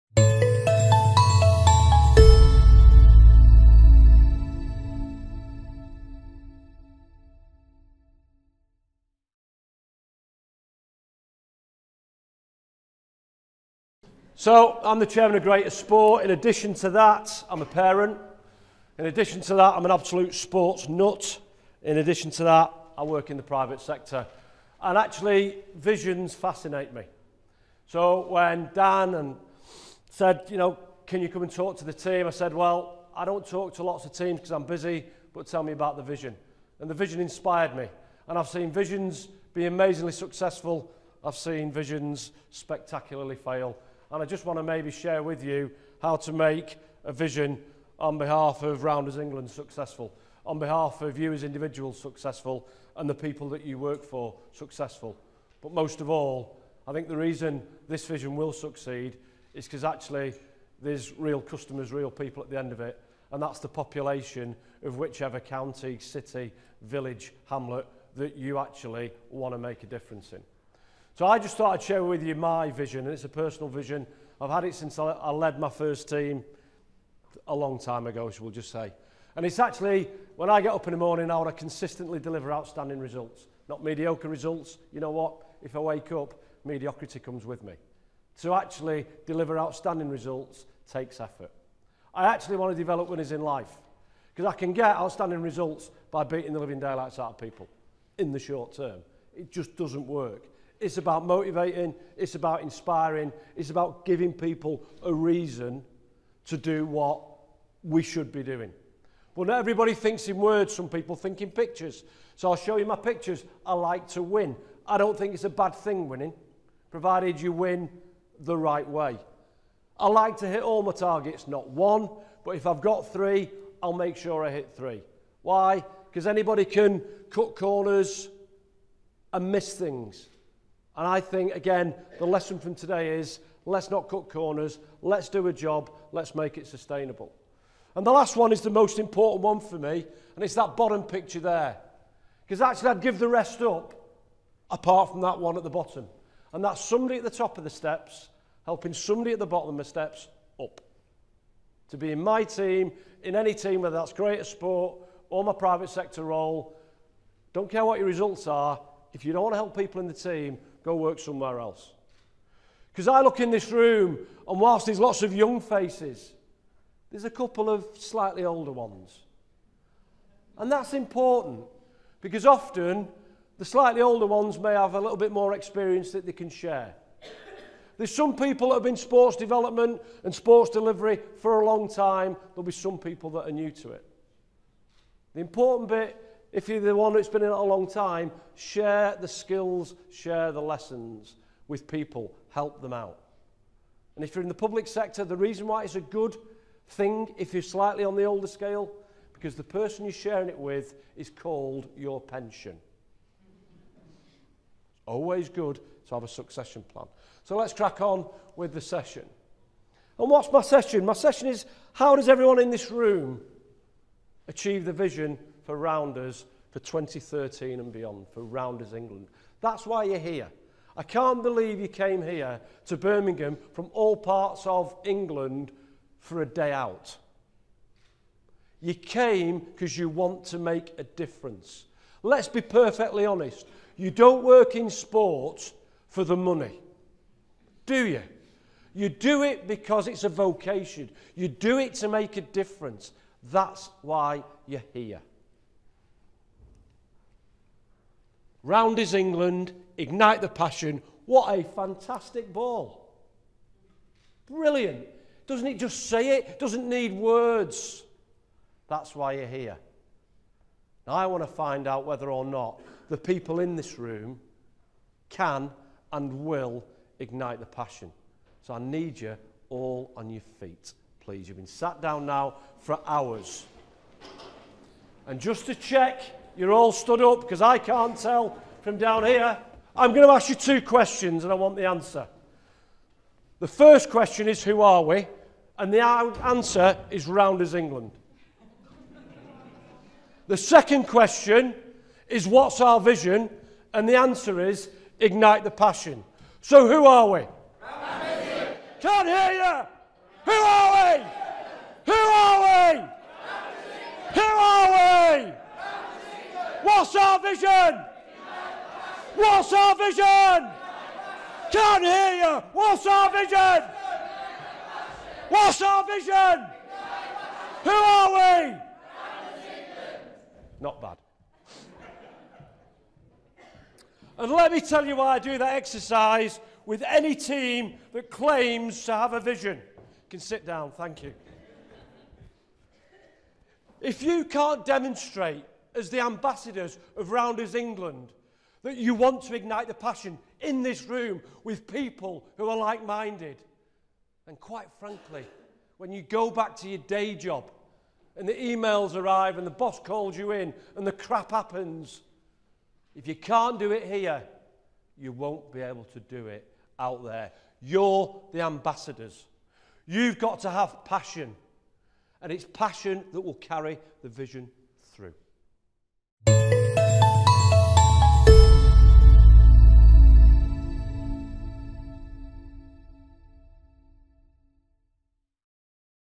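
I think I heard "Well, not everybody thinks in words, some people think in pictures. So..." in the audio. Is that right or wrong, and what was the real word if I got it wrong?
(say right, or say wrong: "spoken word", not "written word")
right.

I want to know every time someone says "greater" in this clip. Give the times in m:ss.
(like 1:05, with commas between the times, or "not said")
0:15, 2:34.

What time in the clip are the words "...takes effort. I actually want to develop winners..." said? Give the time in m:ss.
1:30.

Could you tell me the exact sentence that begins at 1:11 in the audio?
So I just thought I'd share with you my vision, and it's a personal vision.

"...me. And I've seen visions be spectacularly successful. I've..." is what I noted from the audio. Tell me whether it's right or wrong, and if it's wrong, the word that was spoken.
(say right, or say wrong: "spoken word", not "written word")
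wrong: "amazingly", not "spectacularly".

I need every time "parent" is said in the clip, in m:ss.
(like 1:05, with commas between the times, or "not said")
0:17.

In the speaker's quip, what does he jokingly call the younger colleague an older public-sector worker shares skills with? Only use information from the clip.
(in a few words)
your pension.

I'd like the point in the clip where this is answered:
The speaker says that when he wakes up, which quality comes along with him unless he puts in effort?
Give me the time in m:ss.
1:26.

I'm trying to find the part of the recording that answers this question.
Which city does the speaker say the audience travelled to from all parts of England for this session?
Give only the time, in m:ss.
3:42.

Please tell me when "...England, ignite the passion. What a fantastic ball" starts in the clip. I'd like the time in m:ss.
4:09.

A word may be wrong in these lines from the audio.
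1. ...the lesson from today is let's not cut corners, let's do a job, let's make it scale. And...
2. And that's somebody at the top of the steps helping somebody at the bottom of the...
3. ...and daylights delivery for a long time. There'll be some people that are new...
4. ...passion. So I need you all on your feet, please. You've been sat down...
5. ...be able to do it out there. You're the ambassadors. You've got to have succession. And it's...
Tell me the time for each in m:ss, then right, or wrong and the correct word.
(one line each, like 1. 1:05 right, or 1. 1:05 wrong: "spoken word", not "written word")
1. 2:12 wrong: "sustainable", not "scale"
2. 2:26 right
3. 3:00 wrong: "sports", not "daylights"
4. 4:27 right
5. 5:55 wrong: "passion", not "succession".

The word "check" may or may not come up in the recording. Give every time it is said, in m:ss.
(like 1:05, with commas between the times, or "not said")
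4:35.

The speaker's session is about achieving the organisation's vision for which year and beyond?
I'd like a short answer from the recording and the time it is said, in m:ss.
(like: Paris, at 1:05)
2013, at 3:36.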